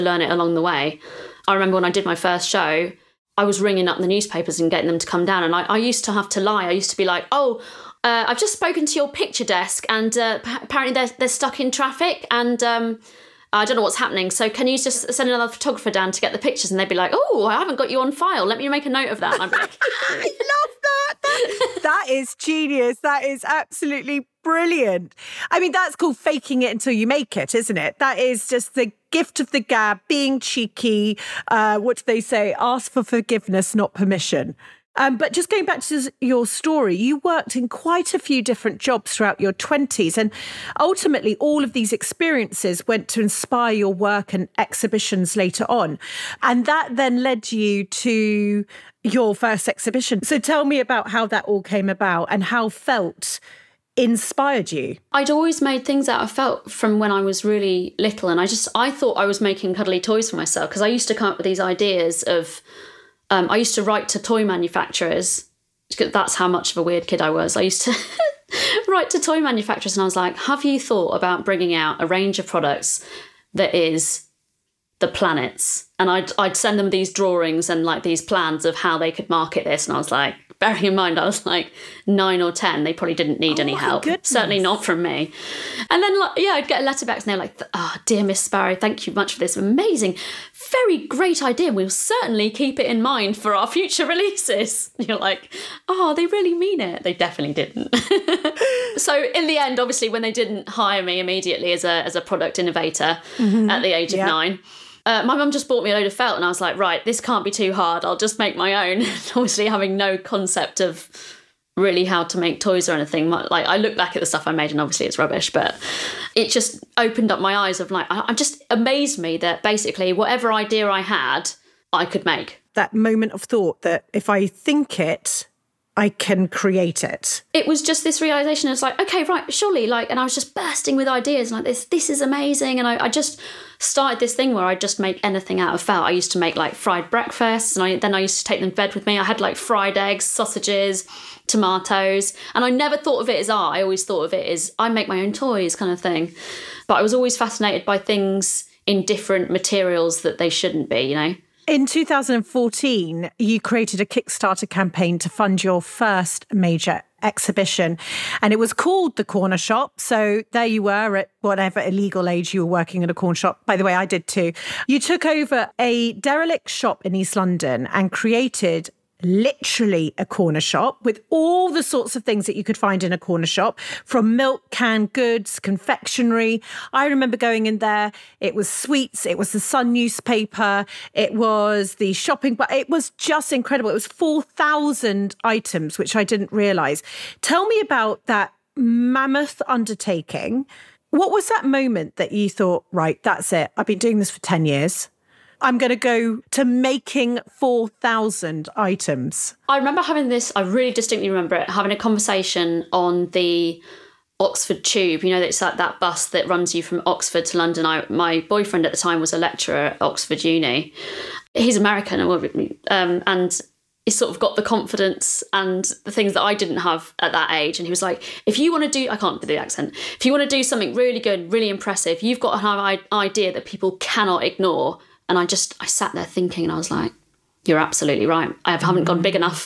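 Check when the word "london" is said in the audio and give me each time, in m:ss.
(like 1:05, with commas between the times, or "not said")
2:47, 3:27.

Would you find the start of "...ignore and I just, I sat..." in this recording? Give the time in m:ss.
3:44.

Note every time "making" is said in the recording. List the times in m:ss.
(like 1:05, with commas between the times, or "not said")
0:59, 3:16.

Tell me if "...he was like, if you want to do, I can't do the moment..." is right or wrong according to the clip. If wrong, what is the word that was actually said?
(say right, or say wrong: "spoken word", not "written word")
wrong: "accent", not "moment".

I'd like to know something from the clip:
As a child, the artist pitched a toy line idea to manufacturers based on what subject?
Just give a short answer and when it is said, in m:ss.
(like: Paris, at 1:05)
The planets, at 1:15.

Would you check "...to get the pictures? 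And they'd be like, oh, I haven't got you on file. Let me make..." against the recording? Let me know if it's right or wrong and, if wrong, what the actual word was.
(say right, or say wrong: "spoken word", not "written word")
right.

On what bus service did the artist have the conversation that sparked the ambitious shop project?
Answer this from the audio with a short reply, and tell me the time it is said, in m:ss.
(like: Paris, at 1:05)
The Oxford Tube, at 3:23.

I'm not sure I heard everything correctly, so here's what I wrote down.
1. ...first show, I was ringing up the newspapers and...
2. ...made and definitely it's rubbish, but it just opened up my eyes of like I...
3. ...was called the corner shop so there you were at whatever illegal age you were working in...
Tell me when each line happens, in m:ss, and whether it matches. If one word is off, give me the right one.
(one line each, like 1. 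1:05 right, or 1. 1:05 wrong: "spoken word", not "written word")
1. 0:02 right
2. 1:54 wrong: "obviously", not "definitely"
3. 2:38 right.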